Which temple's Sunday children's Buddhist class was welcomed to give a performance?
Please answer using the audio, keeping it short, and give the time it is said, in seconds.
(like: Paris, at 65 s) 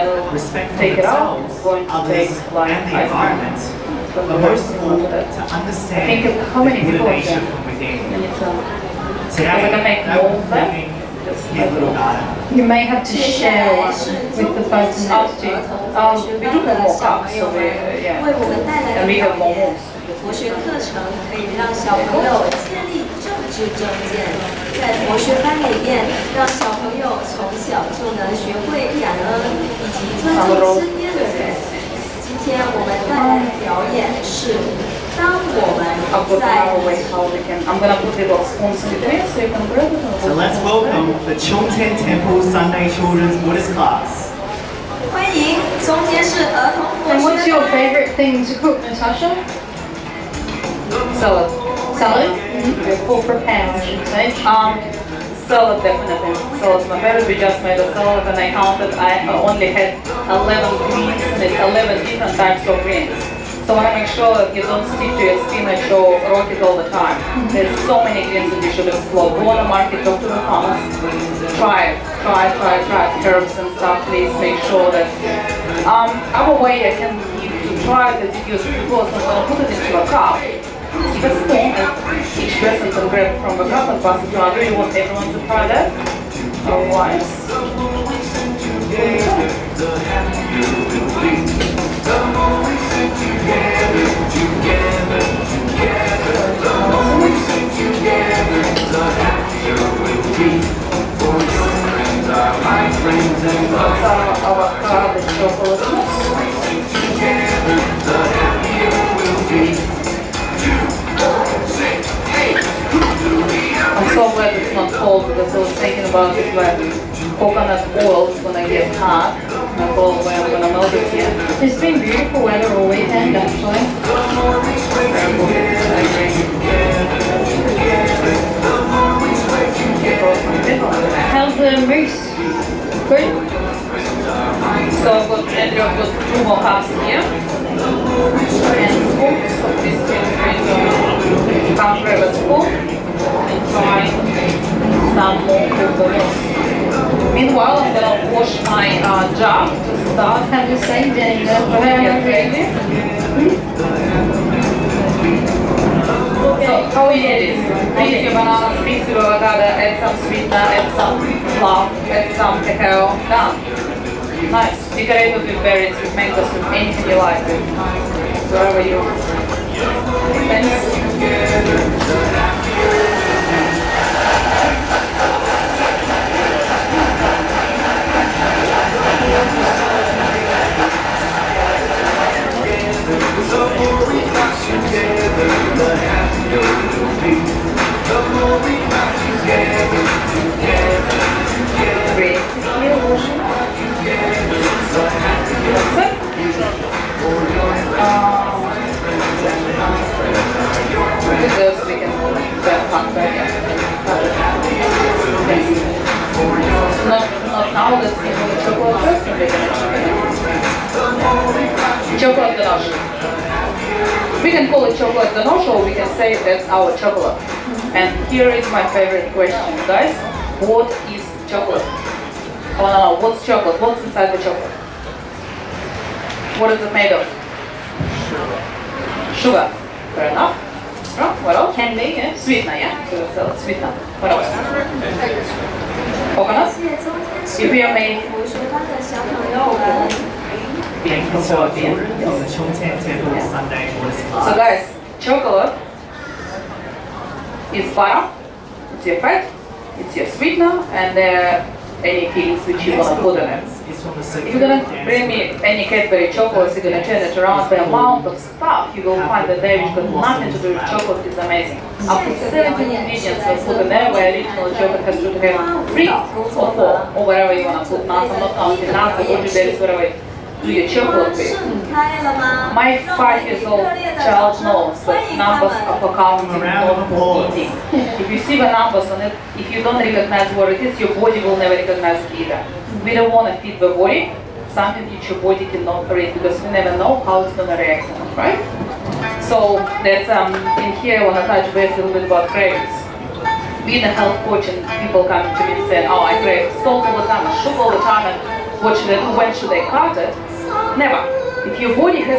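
Chongtian Temple, at 41 s.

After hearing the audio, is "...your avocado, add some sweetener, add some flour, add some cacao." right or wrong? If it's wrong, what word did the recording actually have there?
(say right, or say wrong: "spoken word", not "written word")
right.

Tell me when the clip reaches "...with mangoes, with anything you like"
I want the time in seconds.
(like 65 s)
166 s.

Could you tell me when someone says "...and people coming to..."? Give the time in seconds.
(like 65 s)
294 s.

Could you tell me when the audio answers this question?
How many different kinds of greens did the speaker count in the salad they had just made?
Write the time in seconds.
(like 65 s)
61 s.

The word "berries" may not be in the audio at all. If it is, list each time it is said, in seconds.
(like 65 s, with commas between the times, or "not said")
165 s, 269 s.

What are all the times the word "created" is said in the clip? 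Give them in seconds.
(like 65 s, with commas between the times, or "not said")
not said.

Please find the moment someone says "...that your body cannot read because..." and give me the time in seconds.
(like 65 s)
285 s.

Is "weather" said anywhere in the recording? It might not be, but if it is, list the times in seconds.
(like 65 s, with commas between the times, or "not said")
122 s.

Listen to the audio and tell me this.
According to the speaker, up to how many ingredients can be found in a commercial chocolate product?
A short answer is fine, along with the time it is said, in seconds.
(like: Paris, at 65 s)
17, at 262 s.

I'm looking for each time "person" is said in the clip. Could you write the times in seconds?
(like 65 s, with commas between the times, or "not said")
14 s.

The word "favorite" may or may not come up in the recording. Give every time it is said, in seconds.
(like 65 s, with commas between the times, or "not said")
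47 s, 57 s.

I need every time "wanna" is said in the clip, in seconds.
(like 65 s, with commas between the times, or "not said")
267 s, 291 s.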